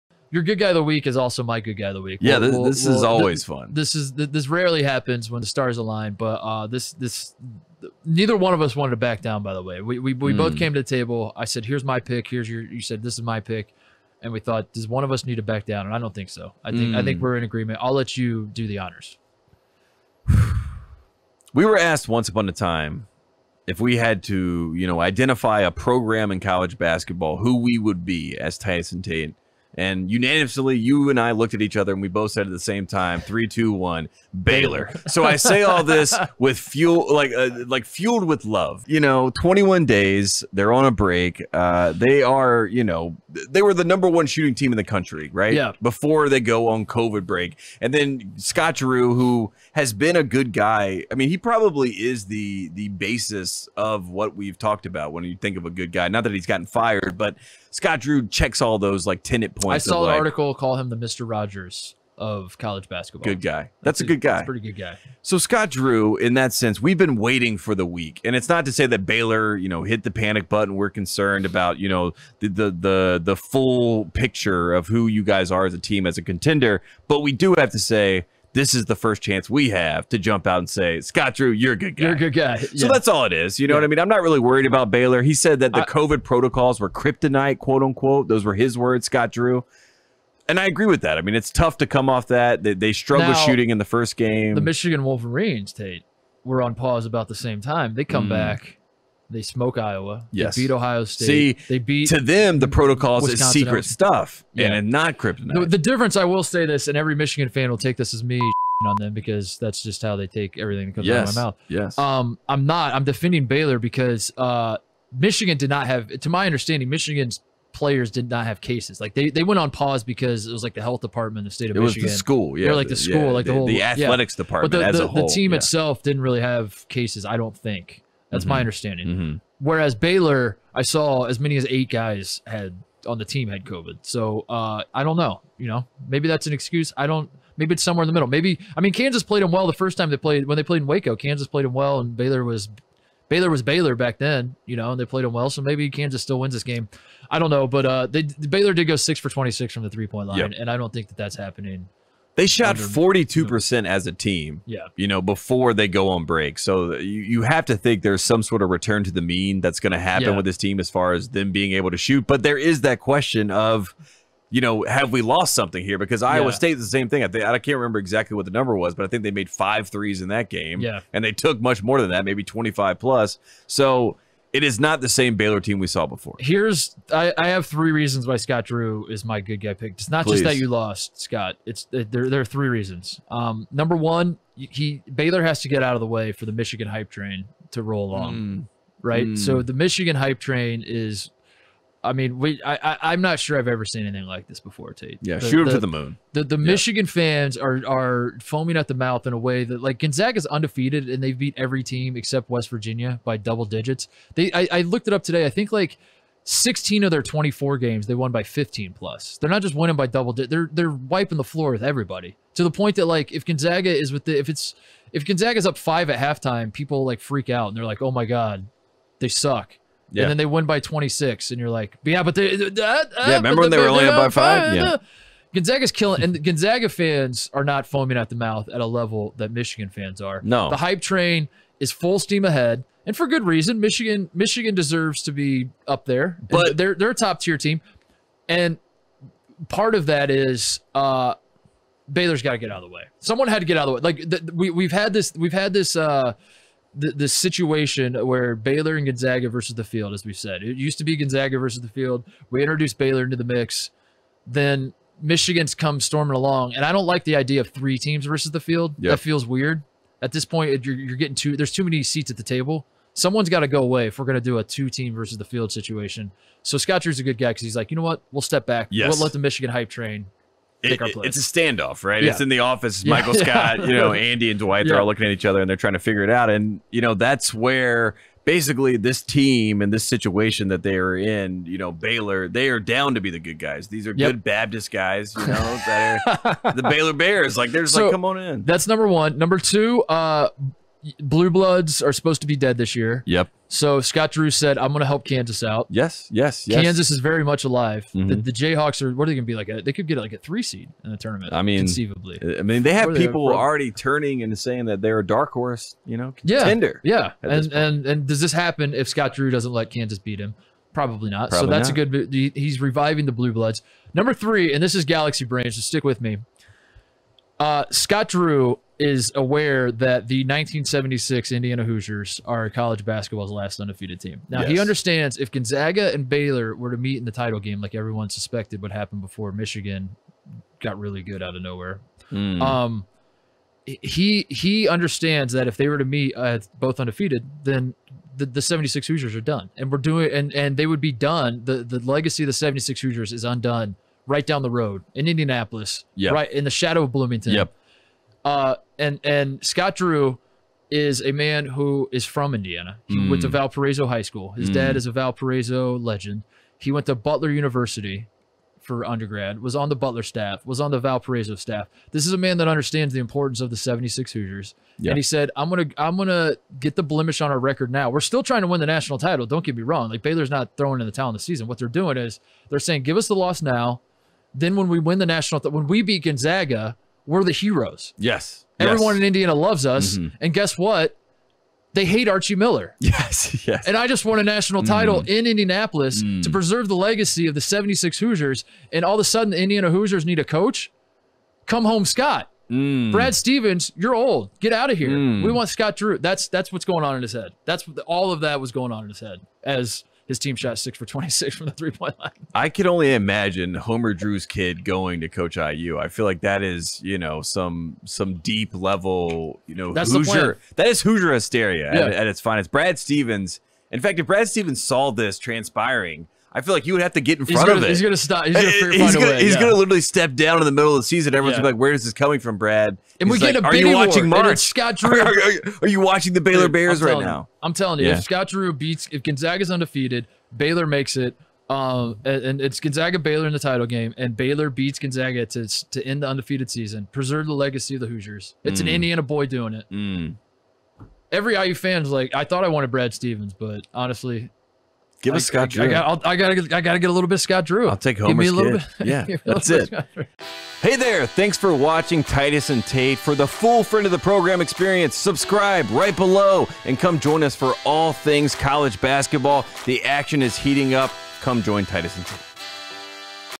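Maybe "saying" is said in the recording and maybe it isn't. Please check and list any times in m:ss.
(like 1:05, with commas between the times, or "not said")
5:04, 6:12.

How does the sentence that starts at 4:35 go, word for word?
all looking at each other and they're trying to figure it out.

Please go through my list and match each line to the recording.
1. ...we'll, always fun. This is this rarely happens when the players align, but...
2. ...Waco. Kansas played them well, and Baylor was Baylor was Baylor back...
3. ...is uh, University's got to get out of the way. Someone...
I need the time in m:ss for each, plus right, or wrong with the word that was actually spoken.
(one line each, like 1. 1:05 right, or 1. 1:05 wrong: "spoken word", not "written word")
1. 0:03 wrong: "stars", not "players"
2. 2:20 right
3. 4:00 wrong: "Baylor", not "University".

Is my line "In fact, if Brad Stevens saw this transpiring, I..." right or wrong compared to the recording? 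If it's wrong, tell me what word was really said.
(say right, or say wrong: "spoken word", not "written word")
right.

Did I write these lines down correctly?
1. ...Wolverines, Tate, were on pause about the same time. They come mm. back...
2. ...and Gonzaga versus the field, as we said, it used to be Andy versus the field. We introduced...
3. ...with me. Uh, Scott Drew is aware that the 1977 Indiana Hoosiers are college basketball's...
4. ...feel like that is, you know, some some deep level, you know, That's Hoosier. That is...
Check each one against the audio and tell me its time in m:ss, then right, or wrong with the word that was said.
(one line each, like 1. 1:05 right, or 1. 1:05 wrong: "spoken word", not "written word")
1. 1:35 right
2. 4:08 wrong: "Gonzaga", not "Andy"
3. 5:16 wrong: "1976", not "1977"
4. 6:46 right.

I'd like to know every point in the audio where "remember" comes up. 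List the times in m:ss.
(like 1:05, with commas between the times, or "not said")
2:47, 3:43.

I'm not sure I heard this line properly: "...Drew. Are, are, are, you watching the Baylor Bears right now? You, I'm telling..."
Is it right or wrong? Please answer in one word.
right.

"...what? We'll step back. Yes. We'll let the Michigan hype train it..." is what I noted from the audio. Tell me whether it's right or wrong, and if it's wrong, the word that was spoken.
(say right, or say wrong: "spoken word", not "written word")
right.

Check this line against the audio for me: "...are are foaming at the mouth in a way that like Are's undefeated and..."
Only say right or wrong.
wrong.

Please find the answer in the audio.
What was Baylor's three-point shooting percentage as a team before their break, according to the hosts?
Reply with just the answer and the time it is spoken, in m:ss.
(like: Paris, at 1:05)
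42%, at 2:32.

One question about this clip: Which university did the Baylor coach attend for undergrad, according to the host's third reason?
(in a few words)
Butler University.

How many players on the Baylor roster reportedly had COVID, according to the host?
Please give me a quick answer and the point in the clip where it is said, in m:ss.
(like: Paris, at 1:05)
8, at 2:11.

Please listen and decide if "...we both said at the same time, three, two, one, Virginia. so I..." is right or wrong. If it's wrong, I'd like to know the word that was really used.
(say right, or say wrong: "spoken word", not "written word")
wrong: "Baylor", not "Virginia".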